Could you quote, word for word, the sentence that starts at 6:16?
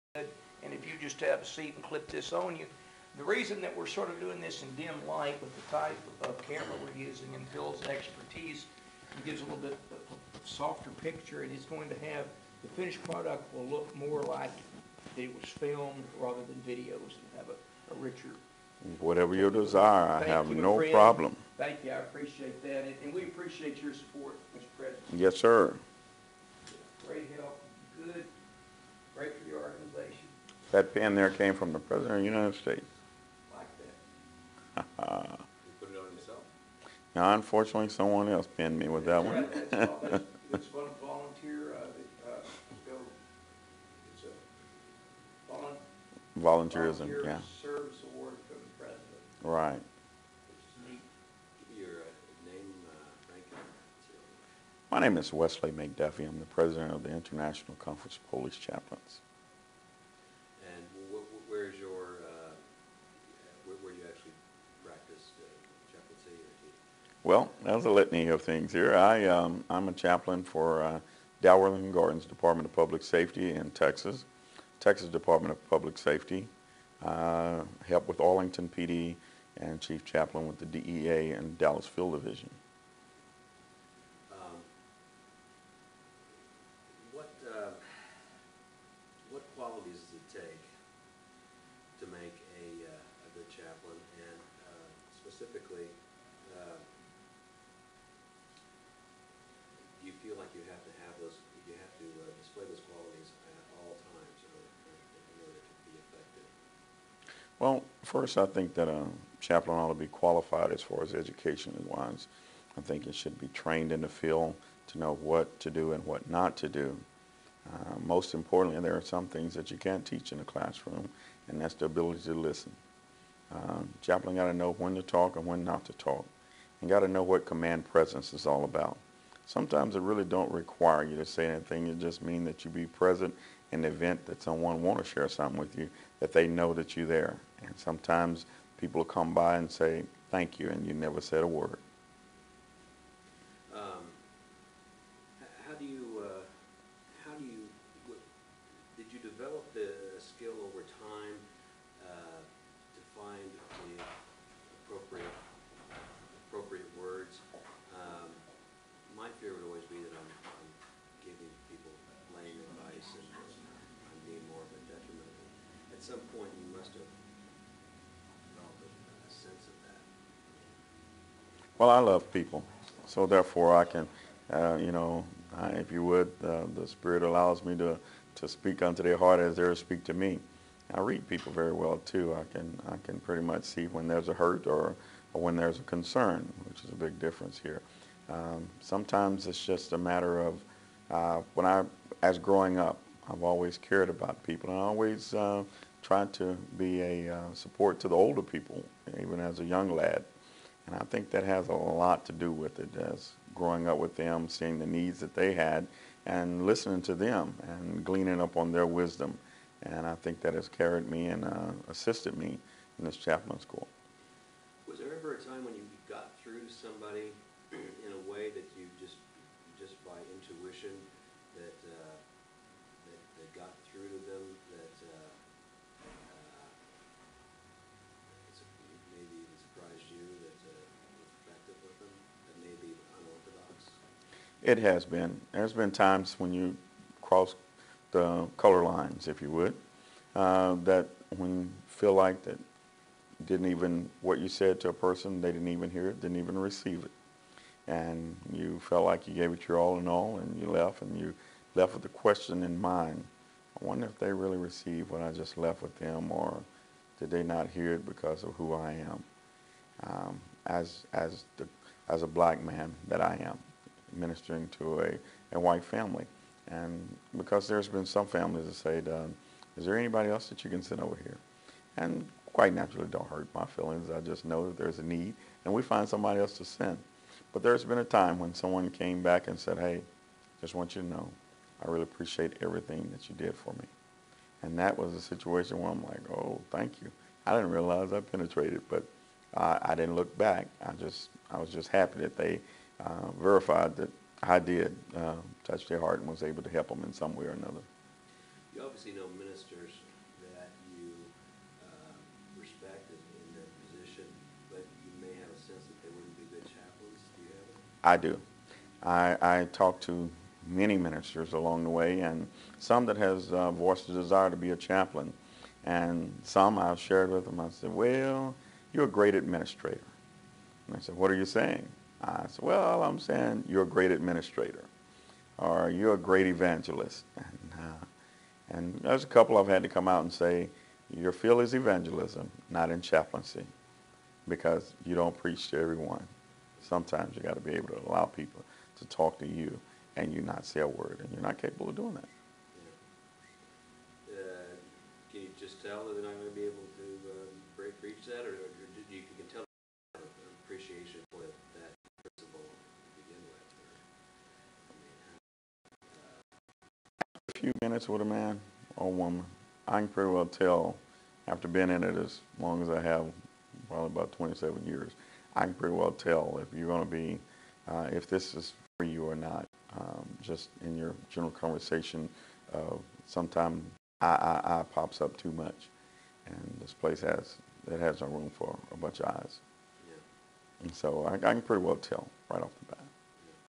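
And this place has, it has no room for a bunch of eyes.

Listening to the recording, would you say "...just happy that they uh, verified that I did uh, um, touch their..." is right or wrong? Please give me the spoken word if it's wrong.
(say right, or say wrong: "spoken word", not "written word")
right.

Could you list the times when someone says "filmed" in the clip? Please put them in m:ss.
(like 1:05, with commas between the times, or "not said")
0:15.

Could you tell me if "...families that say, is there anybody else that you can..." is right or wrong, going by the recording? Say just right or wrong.
right.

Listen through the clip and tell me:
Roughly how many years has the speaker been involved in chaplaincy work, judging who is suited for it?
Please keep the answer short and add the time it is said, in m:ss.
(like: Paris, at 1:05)
27 years, at 6:04.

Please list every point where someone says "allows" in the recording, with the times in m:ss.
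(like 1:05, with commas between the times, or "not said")
2:57, 5:38.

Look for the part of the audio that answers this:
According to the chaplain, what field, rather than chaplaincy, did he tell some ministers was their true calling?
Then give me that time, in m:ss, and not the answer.
5:31.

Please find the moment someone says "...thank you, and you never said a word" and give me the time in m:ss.
2:20.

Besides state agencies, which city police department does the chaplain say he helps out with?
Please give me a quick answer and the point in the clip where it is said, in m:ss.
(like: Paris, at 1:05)
Arlington PD, at 1:18.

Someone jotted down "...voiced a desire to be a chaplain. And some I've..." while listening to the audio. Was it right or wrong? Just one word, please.
right.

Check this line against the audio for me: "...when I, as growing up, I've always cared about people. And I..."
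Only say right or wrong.
right.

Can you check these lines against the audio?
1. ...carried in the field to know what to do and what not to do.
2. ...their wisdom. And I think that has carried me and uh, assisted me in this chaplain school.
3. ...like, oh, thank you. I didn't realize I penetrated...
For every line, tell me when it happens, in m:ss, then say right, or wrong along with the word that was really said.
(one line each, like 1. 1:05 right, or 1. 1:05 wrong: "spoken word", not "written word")
1. 1:53 wrong: "trained", not "carried"
2. 3:28 right
3. 4:46 right.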